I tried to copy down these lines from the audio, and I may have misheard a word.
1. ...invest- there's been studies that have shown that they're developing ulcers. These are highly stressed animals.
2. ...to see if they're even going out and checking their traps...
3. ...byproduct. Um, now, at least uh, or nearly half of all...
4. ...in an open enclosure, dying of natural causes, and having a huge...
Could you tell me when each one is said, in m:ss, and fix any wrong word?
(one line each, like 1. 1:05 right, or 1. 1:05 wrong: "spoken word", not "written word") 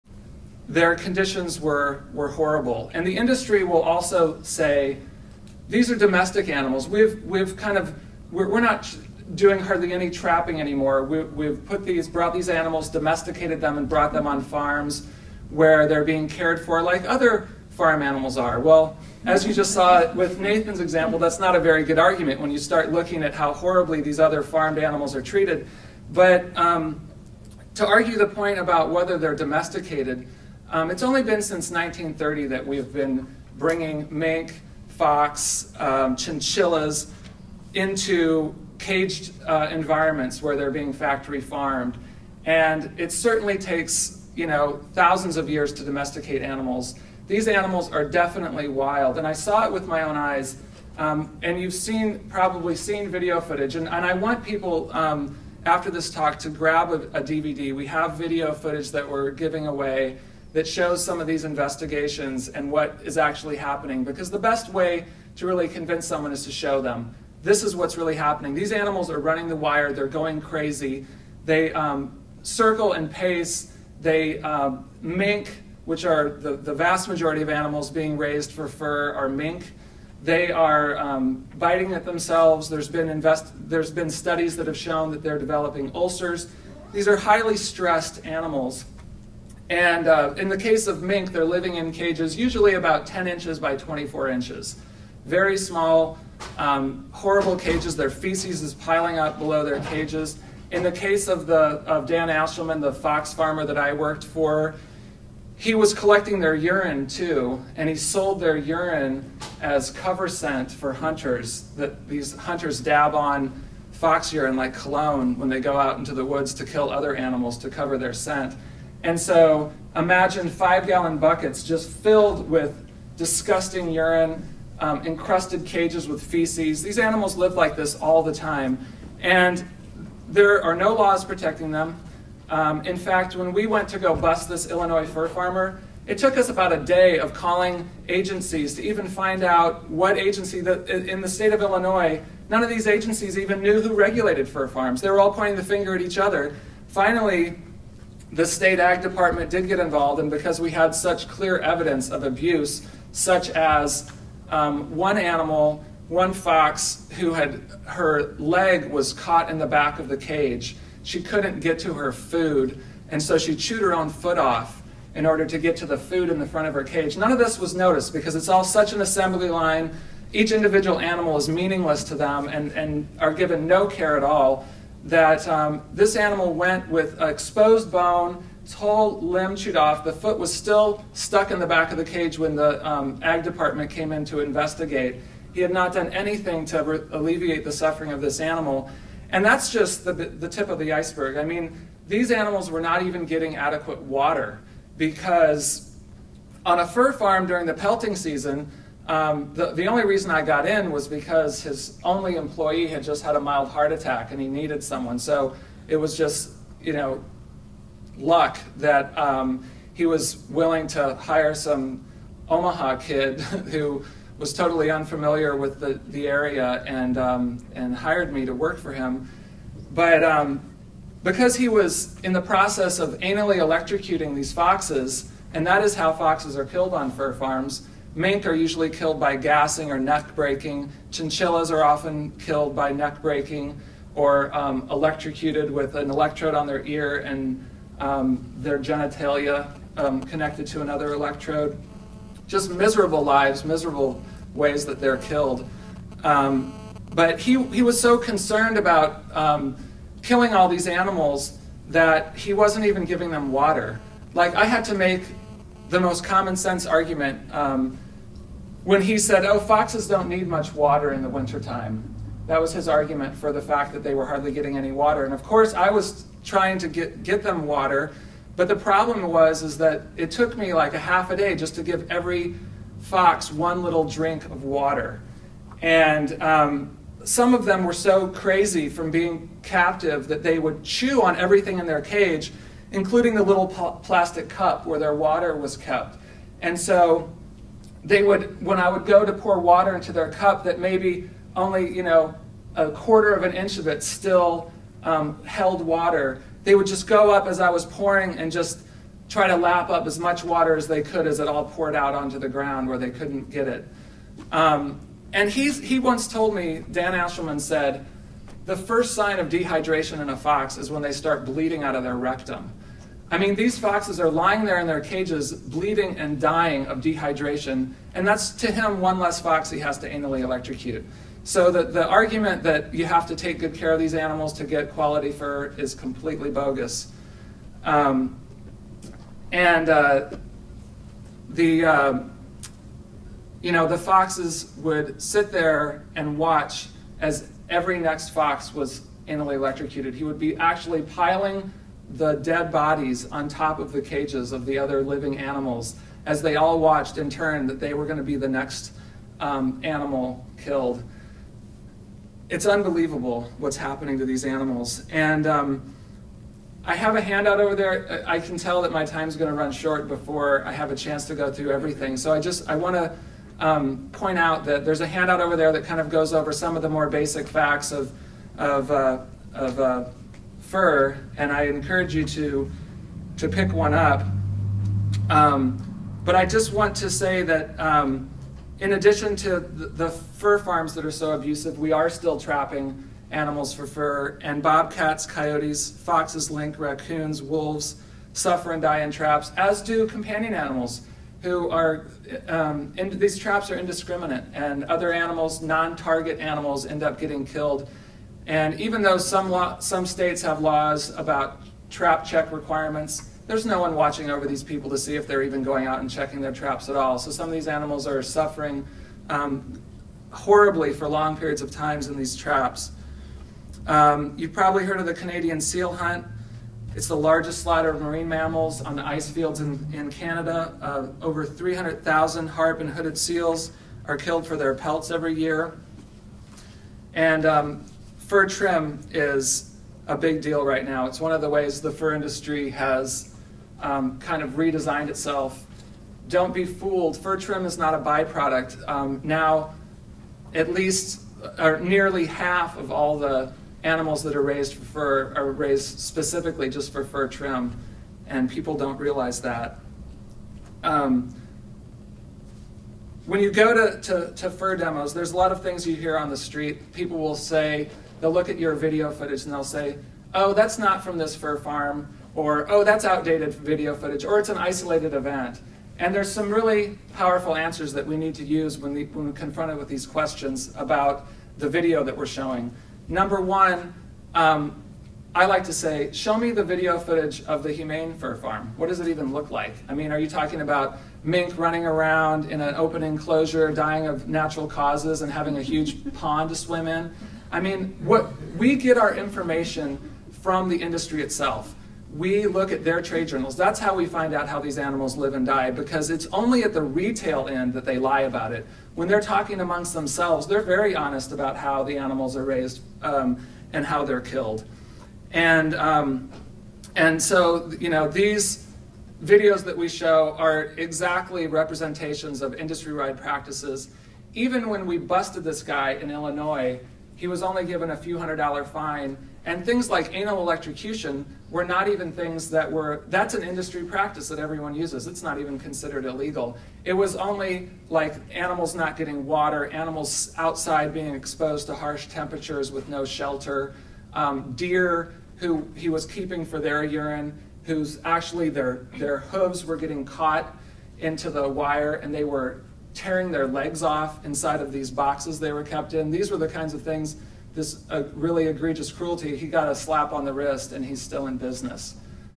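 1. 1:23 right
2. 6:44 right
3. 7:17 right
4. 8:02 right.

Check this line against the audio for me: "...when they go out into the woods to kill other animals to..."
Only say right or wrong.
right.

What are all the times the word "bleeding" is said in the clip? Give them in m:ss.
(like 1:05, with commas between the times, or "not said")
5:11, 5:15.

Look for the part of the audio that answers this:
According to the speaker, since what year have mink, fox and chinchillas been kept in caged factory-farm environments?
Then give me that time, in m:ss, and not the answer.
0:31.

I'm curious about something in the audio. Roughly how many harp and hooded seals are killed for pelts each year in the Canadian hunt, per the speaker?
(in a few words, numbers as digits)
over 300,000.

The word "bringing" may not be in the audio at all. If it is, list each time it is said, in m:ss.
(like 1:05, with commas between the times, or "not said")
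0:33.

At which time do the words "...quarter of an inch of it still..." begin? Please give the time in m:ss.
4:52.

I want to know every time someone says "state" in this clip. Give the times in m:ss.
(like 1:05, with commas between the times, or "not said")
2:21, 2:28, 6:40.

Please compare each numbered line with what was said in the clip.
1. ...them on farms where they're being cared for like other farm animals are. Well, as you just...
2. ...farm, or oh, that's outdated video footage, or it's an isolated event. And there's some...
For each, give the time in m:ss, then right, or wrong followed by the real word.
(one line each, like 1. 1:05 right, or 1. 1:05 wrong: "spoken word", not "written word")
1. 0:14 right
2. 7:41 right.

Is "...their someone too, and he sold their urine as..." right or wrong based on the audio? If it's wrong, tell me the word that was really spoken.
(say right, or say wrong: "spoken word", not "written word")
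wrong: "urine", not "someone".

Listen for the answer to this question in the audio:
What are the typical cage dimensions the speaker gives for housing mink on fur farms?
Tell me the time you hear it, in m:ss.
1:33.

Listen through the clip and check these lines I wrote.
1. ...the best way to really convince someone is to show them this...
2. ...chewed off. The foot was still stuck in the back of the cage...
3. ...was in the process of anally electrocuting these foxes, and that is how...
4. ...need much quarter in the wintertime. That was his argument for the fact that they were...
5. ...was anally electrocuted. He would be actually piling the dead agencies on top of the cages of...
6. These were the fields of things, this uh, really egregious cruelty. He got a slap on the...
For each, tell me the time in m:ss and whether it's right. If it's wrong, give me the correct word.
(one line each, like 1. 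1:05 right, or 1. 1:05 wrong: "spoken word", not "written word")
1. 1:04 right
2. 2:59 right
3. 3:41 right
4. 4:20 wrong: "water", not "quarter"
5. 5:38 wrong: "bodies", not "agencies"
6. 9:06 wrong: "kinds", not "fields".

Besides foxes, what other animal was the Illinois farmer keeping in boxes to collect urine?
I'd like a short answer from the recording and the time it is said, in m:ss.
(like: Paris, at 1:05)
deer, at 8:54.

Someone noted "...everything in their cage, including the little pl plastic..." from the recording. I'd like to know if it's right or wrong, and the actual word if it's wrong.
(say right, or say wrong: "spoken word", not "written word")
right.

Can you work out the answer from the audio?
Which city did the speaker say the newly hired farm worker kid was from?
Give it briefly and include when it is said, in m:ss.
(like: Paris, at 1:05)
Omaha, at 3:32.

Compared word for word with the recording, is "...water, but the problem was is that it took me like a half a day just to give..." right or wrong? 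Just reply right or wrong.
right.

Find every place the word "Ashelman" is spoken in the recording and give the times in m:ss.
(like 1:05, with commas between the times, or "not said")
1:42, 5:07.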